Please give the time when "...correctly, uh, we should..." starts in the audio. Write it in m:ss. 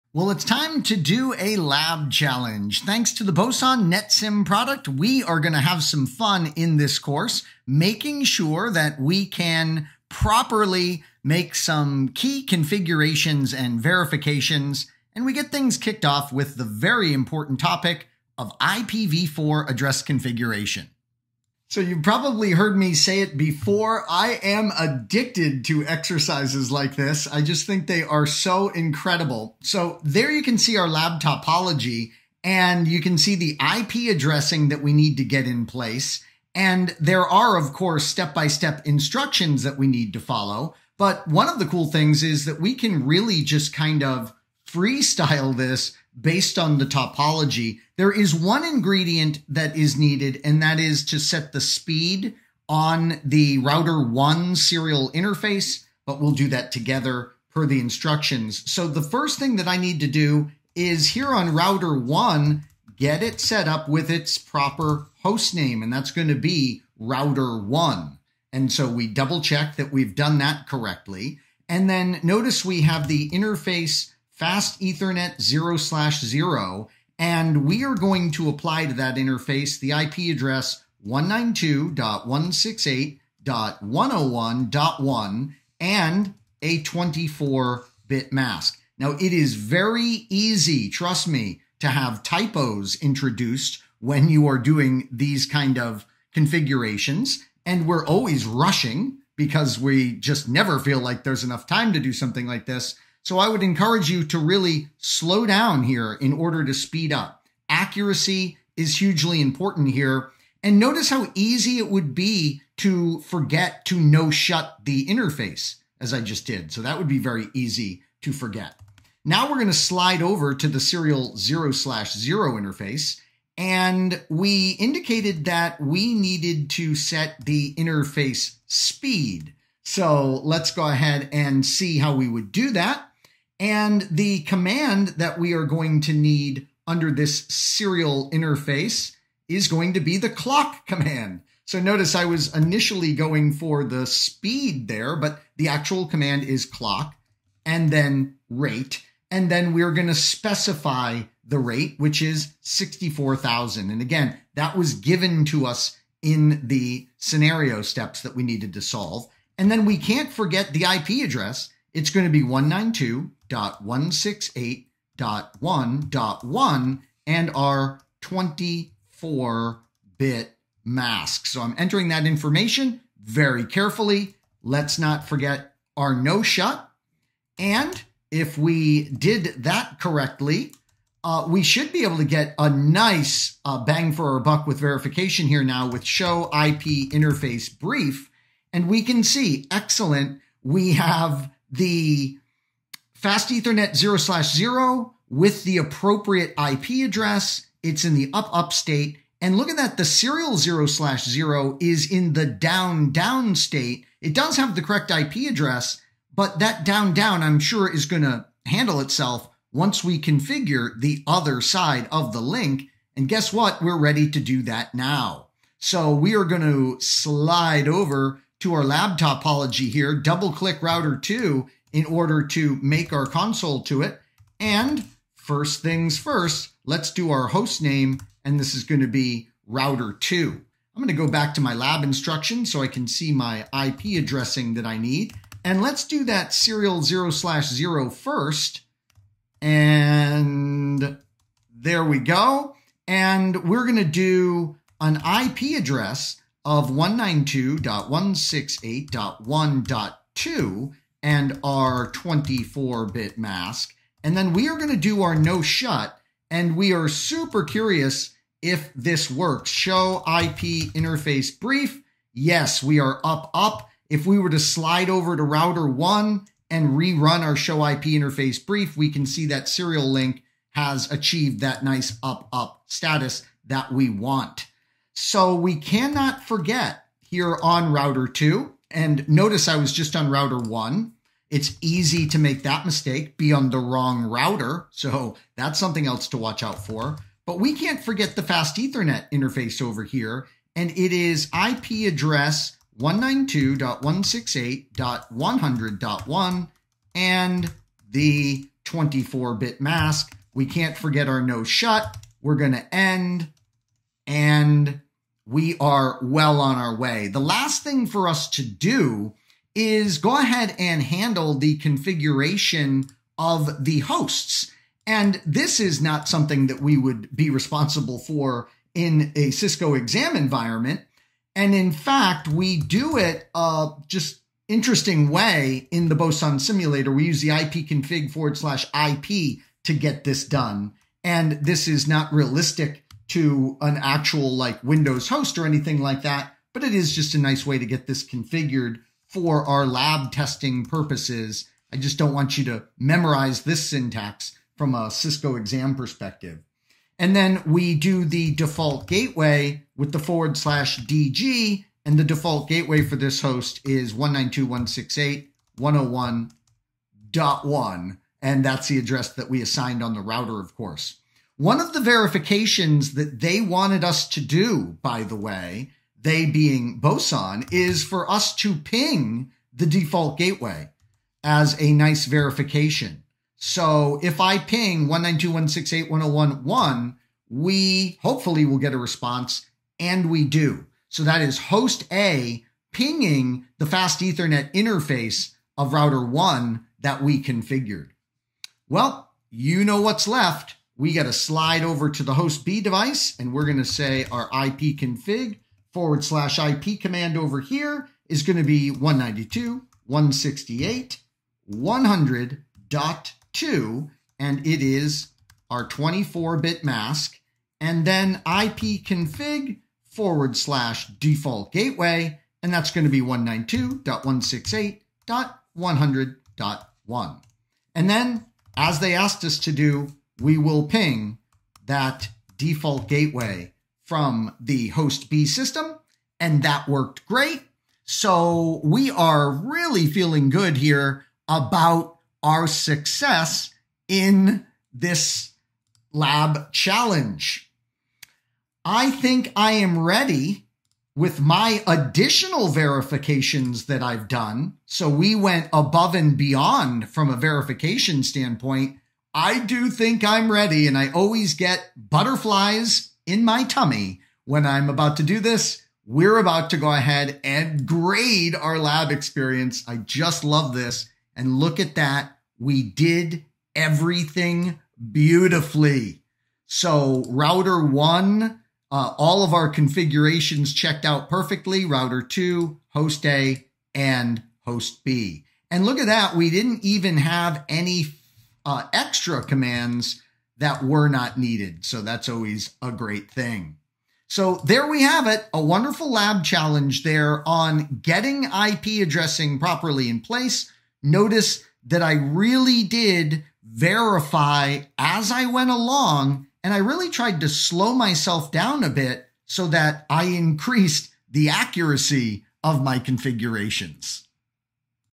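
2:59.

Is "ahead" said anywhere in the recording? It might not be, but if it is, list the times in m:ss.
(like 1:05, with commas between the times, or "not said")
2:10, 5:10, 7:36.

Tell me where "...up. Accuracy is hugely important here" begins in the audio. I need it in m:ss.
1:47.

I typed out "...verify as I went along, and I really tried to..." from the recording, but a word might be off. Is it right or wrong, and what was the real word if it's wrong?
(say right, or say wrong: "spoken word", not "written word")
right.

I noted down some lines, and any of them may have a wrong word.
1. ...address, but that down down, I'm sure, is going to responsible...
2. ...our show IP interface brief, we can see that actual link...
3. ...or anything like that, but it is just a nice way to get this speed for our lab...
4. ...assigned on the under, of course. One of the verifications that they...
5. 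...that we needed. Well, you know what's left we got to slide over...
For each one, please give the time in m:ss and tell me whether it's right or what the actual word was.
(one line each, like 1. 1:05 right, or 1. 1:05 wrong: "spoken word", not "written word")
1. 3:25 wrong: "handle", not "responsible"
2. 4:27 wrong: "serial", not "actual"
3. 5:35 wrong: "configured", not "speed"
4. 5:59 wrong: "router", not "under"
5. 6:27 wrong: "configured", not "needed".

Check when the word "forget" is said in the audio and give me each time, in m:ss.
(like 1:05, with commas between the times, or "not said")
1:53, 1:58, 2:40, 2:55, 4:36, 4:48, 5:00.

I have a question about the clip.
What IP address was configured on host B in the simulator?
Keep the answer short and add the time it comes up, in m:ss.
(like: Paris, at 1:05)
192.168.100.2, at 6:38.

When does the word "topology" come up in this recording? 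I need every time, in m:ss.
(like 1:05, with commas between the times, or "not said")
0:31, 0:46, 3:39.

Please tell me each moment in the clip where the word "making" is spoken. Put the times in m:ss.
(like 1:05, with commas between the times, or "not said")
0:07.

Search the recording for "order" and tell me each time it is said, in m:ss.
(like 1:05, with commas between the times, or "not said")
1:46, 3:42.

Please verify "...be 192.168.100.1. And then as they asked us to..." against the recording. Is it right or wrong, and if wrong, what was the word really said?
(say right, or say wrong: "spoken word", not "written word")
right.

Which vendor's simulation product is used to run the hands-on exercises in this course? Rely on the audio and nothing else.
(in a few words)
Boson NetSim.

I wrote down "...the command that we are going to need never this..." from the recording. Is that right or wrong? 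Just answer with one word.
wrong.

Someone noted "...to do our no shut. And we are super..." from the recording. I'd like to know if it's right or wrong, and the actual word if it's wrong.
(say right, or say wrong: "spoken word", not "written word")
right.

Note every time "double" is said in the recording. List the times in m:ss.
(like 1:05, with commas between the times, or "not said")
1:09, 3:40.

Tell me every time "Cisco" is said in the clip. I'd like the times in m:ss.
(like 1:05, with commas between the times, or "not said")
5:19, 5:45.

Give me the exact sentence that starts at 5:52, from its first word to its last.
And the default gateway for this host is 192.168.101.1.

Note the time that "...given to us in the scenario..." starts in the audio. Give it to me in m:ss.
2:34.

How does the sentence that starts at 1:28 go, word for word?
Now, it is very easy, trust me, to have typos introduced when you are doing these kind of configurations.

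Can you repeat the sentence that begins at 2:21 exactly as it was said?
So notice I was initially going for the speed there, but the actual command is clock and then rate.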